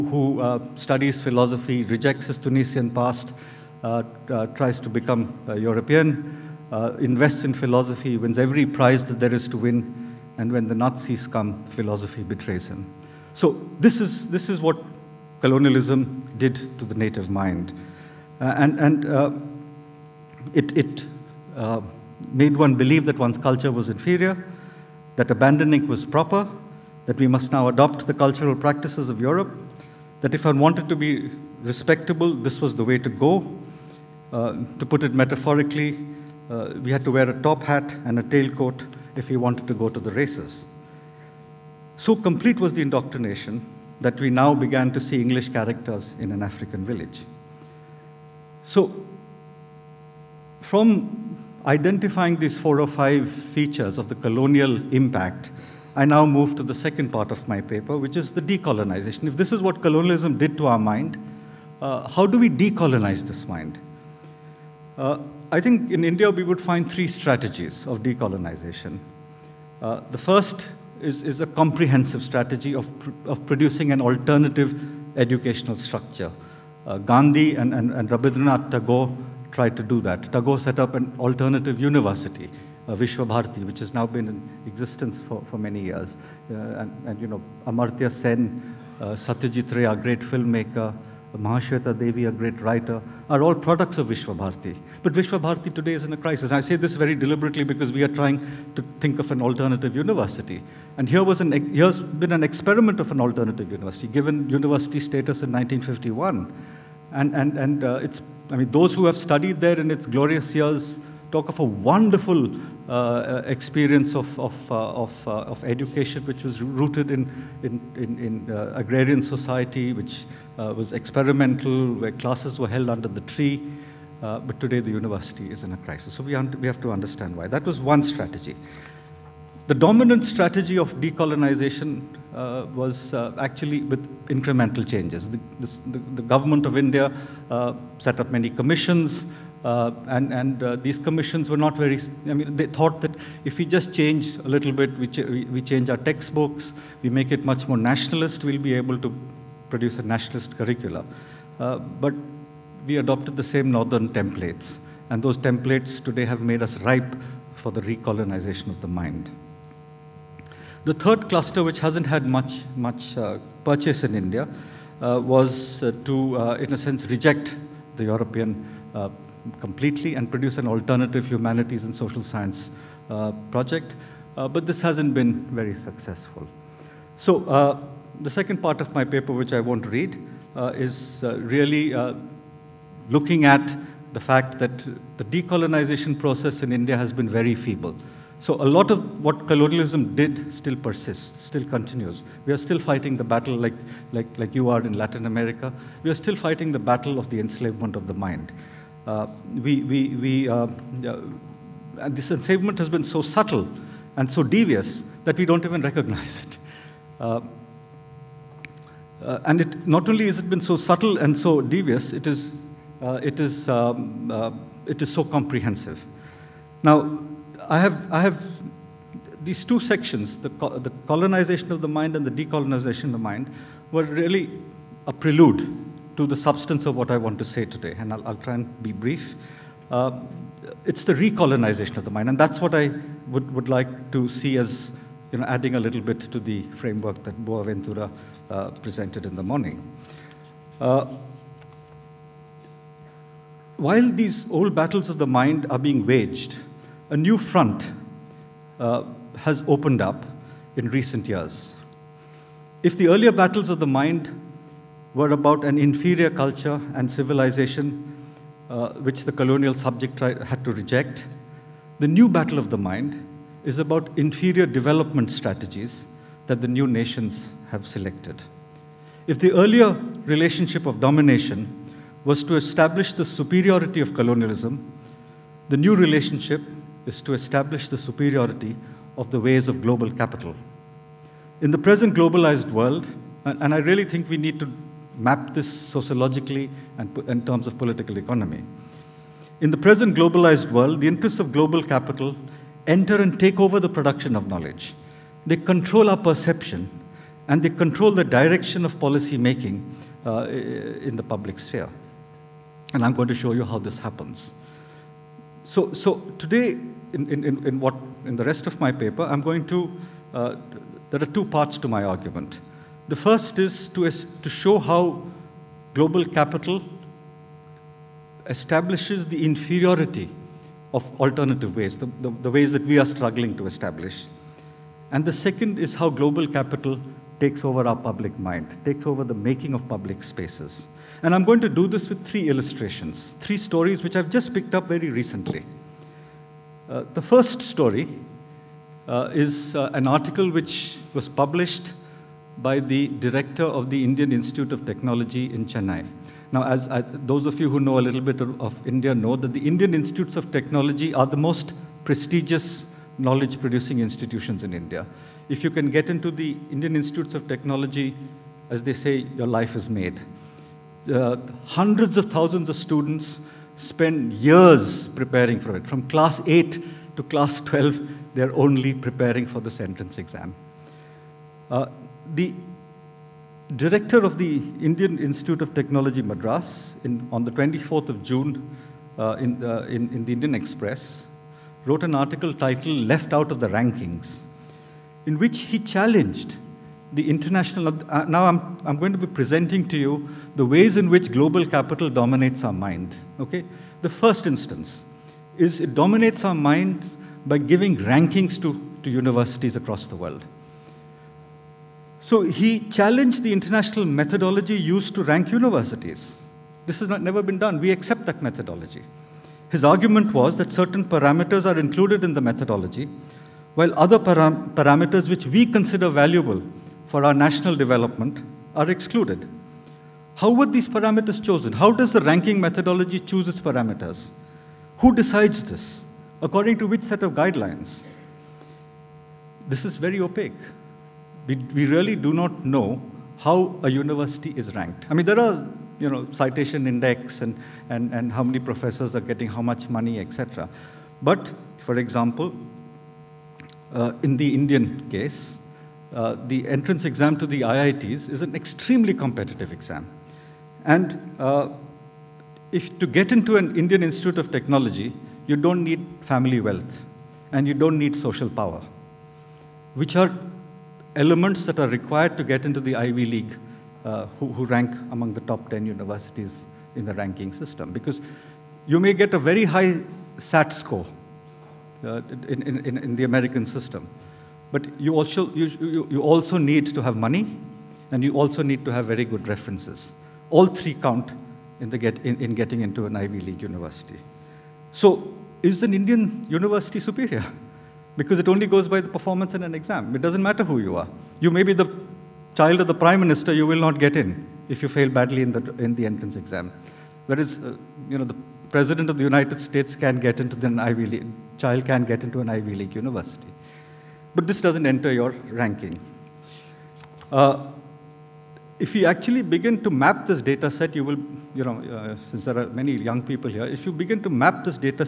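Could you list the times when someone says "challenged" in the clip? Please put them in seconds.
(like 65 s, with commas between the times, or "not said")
385 s, 402 s.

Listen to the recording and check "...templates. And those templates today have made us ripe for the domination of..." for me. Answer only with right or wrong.
wrong.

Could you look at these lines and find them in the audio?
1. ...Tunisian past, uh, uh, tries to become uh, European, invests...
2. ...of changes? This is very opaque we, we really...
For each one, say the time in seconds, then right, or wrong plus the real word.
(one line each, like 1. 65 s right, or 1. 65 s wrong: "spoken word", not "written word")
1. 2 s right
2. 427 s wrong: "guidelines", not "changes".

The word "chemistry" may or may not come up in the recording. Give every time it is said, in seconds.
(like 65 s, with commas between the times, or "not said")
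not said.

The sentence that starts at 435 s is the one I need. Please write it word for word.
I mean, there are you know, citation index and, and, and how many professors are getting how much money, etc.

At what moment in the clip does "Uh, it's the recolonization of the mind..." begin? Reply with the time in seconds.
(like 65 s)
229 s.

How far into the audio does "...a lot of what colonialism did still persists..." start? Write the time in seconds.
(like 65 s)
188 s.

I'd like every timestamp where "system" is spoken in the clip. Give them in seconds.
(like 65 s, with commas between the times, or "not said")
467 s, 473 s.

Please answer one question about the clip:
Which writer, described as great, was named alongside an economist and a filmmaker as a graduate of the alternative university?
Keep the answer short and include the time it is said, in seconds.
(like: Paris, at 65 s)
Mahashweta Devi, at 91 s.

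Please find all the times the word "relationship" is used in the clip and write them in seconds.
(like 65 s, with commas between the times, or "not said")
270 s, 275 s.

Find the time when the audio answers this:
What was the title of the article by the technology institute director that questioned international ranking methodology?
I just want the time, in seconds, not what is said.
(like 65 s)
383 s.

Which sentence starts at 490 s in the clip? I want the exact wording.
It doesn't matter who you are.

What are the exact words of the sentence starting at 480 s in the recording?
All three count in, the get, in, in getting into an Ivy League university.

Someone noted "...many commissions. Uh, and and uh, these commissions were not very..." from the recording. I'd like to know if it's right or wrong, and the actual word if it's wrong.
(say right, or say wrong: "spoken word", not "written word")
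right.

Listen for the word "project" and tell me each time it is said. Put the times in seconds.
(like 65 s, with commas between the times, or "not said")
173 s.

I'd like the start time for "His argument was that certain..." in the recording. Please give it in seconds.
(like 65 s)
409 s.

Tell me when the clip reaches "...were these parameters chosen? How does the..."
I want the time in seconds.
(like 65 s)
420 s.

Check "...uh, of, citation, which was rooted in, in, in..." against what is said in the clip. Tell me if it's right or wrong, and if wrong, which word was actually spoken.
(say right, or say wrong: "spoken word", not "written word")
wrong: "education", not "citation".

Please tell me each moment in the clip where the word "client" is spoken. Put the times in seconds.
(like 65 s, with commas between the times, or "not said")
not said.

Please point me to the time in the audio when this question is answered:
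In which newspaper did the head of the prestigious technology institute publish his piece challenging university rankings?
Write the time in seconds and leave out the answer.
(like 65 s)
380 s.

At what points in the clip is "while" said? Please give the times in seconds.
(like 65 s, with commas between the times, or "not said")
243 s, 413 s.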